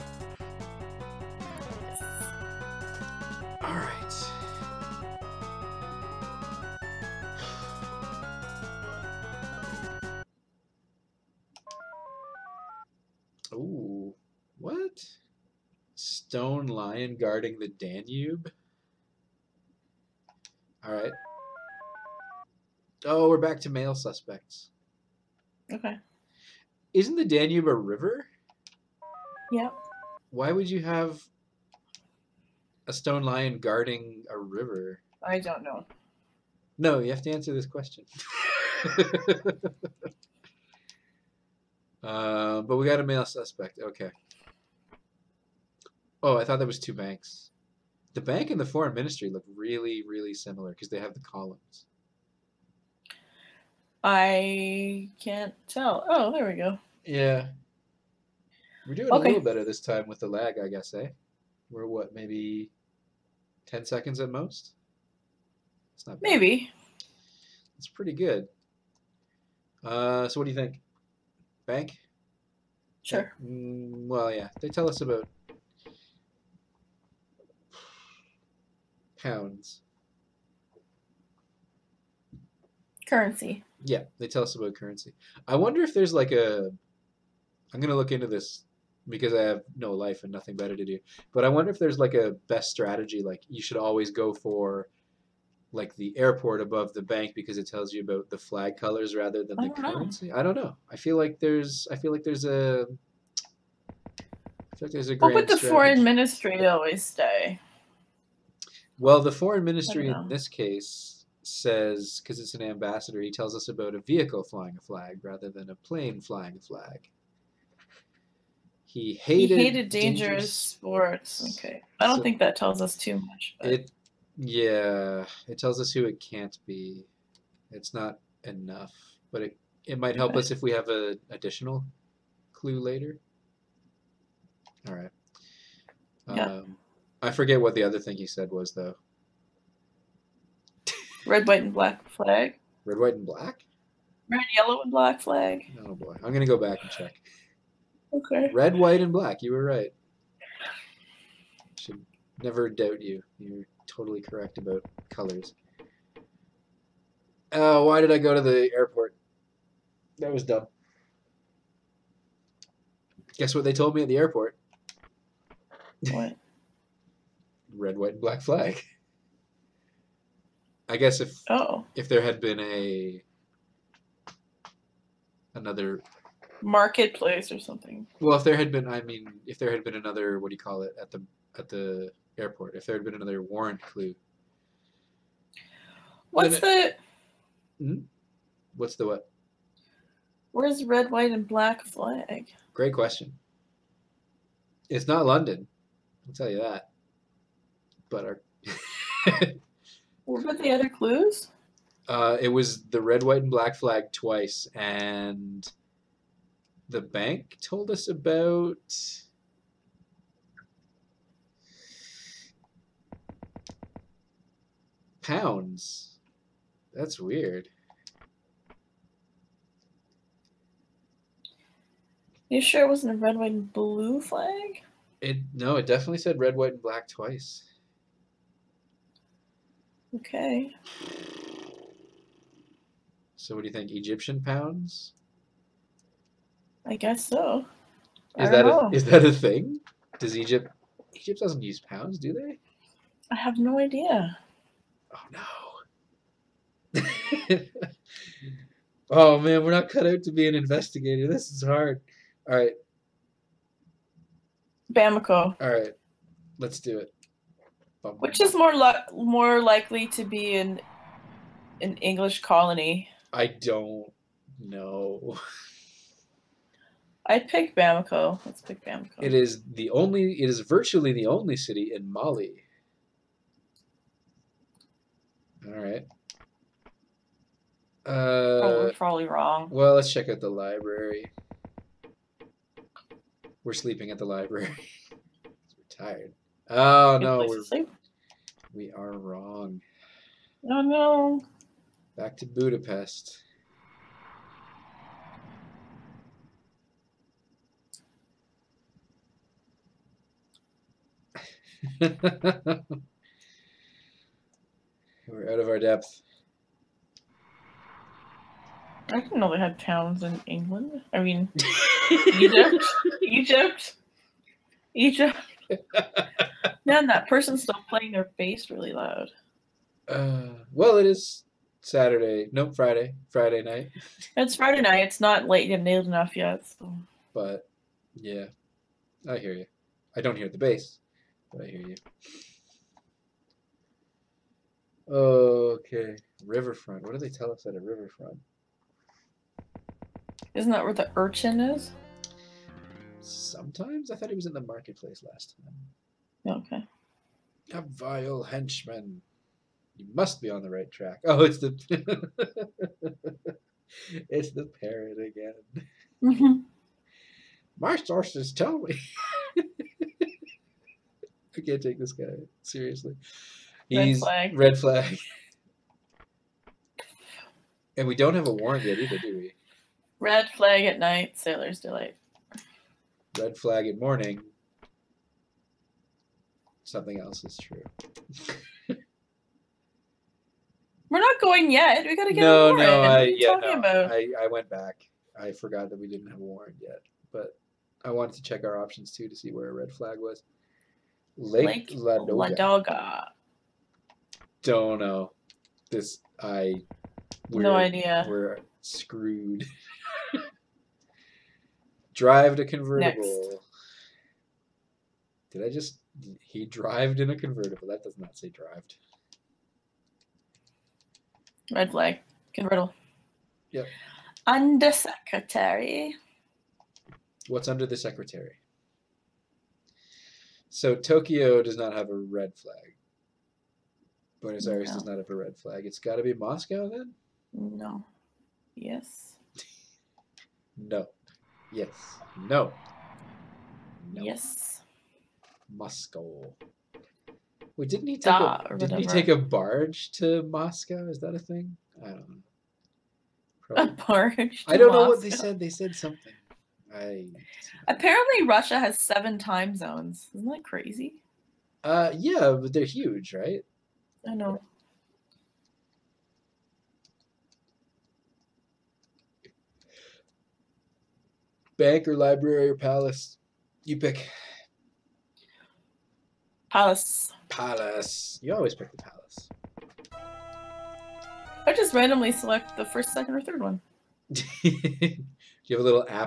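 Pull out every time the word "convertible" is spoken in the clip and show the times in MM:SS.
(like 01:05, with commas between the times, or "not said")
06:42, 06:47, 06:52.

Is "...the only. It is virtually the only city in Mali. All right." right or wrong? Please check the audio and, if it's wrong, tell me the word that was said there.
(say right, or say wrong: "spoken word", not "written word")
right.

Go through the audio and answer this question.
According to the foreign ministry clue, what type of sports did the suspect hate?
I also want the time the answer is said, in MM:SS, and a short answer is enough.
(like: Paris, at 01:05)
Dangerous sports, at 01:59.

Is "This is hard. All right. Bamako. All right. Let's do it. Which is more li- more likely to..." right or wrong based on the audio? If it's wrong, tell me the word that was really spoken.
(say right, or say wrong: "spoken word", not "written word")
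right.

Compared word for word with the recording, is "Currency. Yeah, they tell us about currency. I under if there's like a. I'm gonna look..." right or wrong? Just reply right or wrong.
wrong.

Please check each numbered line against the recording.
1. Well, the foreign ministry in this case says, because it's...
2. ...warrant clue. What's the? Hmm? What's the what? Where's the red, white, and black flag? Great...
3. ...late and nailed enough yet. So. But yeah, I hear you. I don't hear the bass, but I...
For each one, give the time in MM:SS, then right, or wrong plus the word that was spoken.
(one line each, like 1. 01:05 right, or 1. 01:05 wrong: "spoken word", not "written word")
1. 01:48 right
2. 03:03 right
3. 05:25 right.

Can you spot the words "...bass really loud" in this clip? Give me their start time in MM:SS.
05:18.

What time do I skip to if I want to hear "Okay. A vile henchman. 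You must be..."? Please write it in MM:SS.
05:46.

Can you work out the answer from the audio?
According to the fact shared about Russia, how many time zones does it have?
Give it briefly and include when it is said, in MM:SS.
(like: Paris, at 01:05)
7, at 07:28.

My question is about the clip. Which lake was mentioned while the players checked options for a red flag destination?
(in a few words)
Lake Ladoga.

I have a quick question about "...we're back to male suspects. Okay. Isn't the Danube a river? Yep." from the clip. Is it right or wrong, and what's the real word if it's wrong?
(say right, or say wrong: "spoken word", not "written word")
right.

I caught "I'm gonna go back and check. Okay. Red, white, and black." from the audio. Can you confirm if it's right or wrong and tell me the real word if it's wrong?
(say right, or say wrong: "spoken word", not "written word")
right.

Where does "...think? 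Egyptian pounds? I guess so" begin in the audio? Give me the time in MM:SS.
03:53.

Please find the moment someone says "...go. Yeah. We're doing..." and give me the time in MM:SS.
00:56.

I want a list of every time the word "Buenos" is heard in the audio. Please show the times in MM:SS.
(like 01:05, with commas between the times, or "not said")
07:04.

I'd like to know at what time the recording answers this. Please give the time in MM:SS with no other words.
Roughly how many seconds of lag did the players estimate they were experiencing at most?
01:03.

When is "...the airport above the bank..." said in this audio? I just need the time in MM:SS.
01:35.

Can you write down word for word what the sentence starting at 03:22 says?
Uh, it was the red, white, and black flag twice, and the bank told us about.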